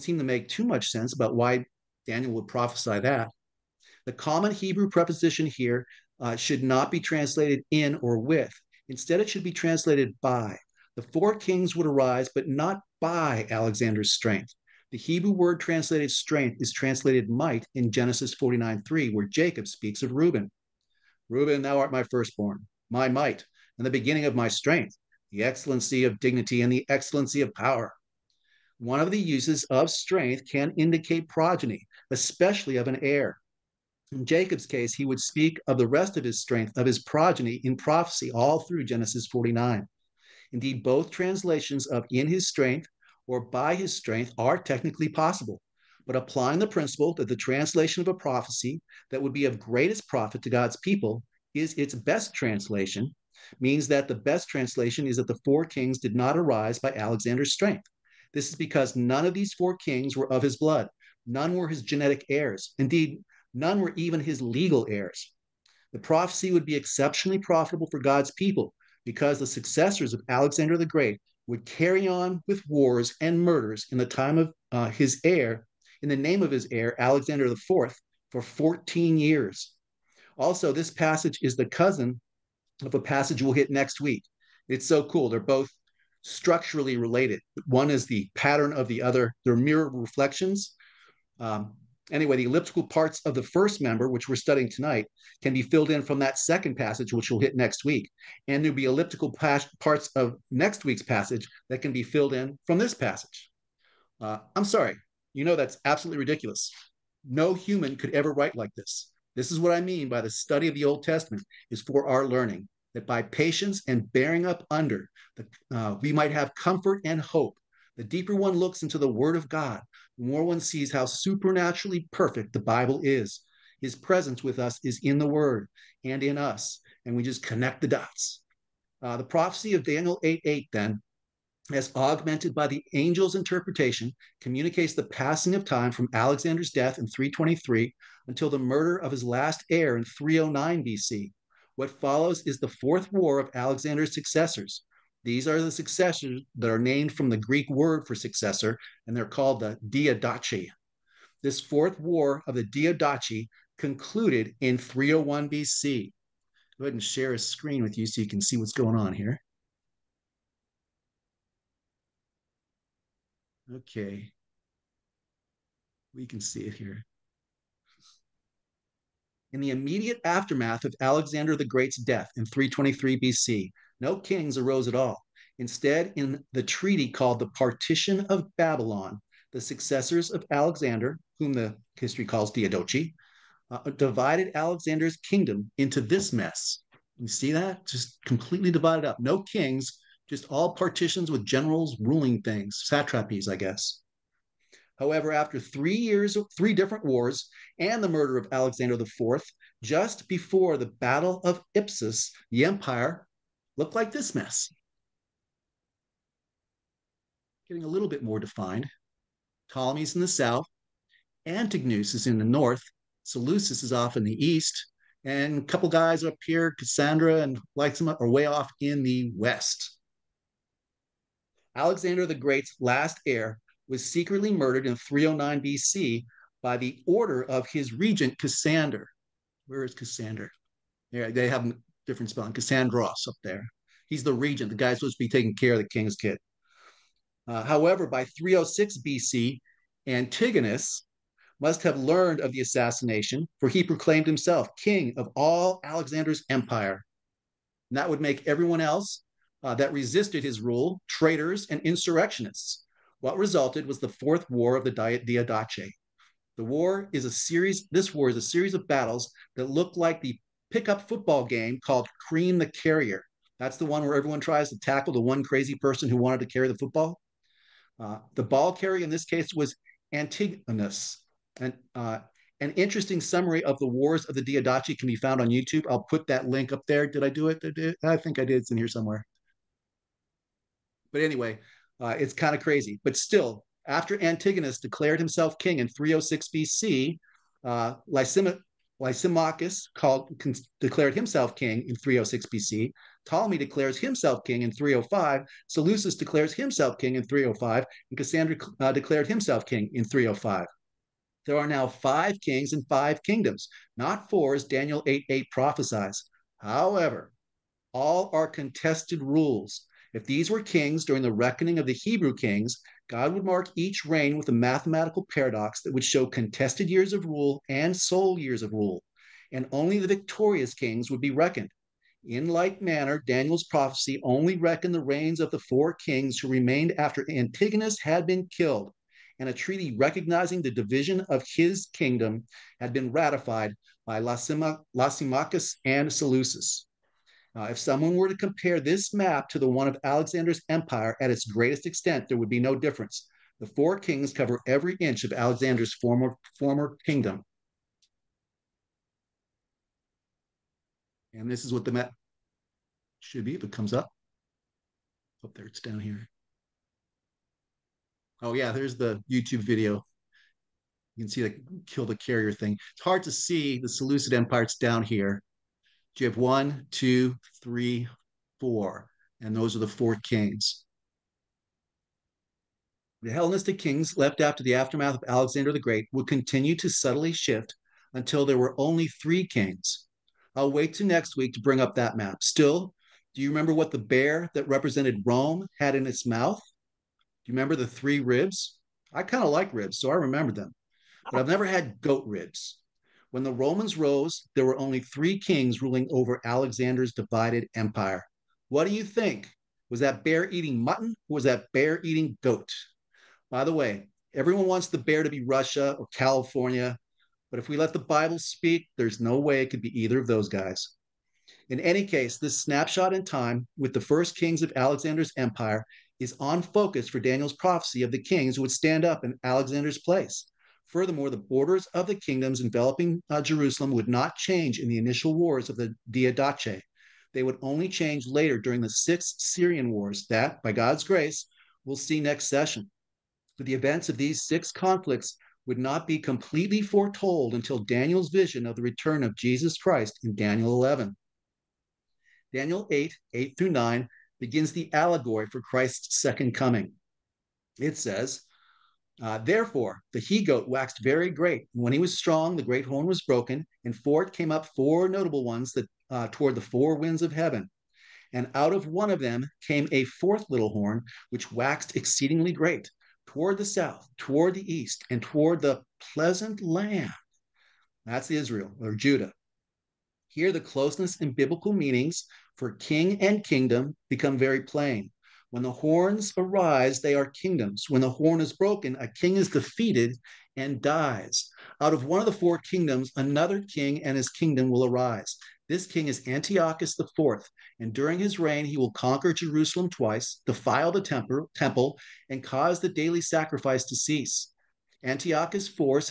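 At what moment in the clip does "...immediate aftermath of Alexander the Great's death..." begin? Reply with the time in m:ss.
2:49.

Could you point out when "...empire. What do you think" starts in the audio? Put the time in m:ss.
6:37.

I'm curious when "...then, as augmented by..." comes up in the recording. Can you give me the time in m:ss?
2:10.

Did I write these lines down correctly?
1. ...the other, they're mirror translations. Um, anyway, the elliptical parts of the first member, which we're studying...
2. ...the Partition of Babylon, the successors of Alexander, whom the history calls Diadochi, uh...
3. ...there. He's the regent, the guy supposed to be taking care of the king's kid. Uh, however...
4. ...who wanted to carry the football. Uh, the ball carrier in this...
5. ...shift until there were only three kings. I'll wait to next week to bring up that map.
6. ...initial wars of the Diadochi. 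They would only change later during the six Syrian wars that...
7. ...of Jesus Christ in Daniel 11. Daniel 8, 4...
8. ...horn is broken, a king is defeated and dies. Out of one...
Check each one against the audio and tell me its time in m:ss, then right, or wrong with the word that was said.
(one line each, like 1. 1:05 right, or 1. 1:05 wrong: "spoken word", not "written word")
1. 1:28 wrong: "reflections", not "translations"
2. 2:57 right
3. 3:53 right
4. 4:26 right
5. 6:17 right
6. 7:04 right
7. 7:19 wrong: "8", not "4"
8. 7:58 right.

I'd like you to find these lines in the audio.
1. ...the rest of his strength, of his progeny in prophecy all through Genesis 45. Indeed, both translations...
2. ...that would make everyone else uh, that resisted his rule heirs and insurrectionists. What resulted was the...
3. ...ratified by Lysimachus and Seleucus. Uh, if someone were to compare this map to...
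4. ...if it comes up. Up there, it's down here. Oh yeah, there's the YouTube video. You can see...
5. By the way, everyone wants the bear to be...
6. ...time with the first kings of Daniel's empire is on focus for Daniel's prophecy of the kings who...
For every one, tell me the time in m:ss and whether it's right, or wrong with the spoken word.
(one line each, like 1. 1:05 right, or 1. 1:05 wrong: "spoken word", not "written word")
1. 0:35 wrong: "49", not "45"
2. 4:07 wrong: "traitors", not "heirs"
3. 5:33 right
4. 5:53 right
5. 6:43 right
6. 6:53 wrong: "Alexander", not "Daniel".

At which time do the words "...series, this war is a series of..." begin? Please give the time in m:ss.
4:17.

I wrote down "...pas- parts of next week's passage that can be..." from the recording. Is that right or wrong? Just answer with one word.
right.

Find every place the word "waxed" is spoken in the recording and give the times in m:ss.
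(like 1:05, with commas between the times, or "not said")
7:30, 7:41.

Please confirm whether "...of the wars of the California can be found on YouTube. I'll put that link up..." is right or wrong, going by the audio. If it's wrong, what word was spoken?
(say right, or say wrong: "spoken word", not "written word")
wrong: "Diadochi", not "California".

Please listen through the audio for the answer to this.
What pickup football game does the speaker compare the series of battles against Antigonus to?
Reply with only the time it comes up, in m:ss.
4:22.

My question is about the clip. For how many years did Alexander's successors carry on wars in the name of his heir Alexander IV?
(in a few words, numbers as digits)
14.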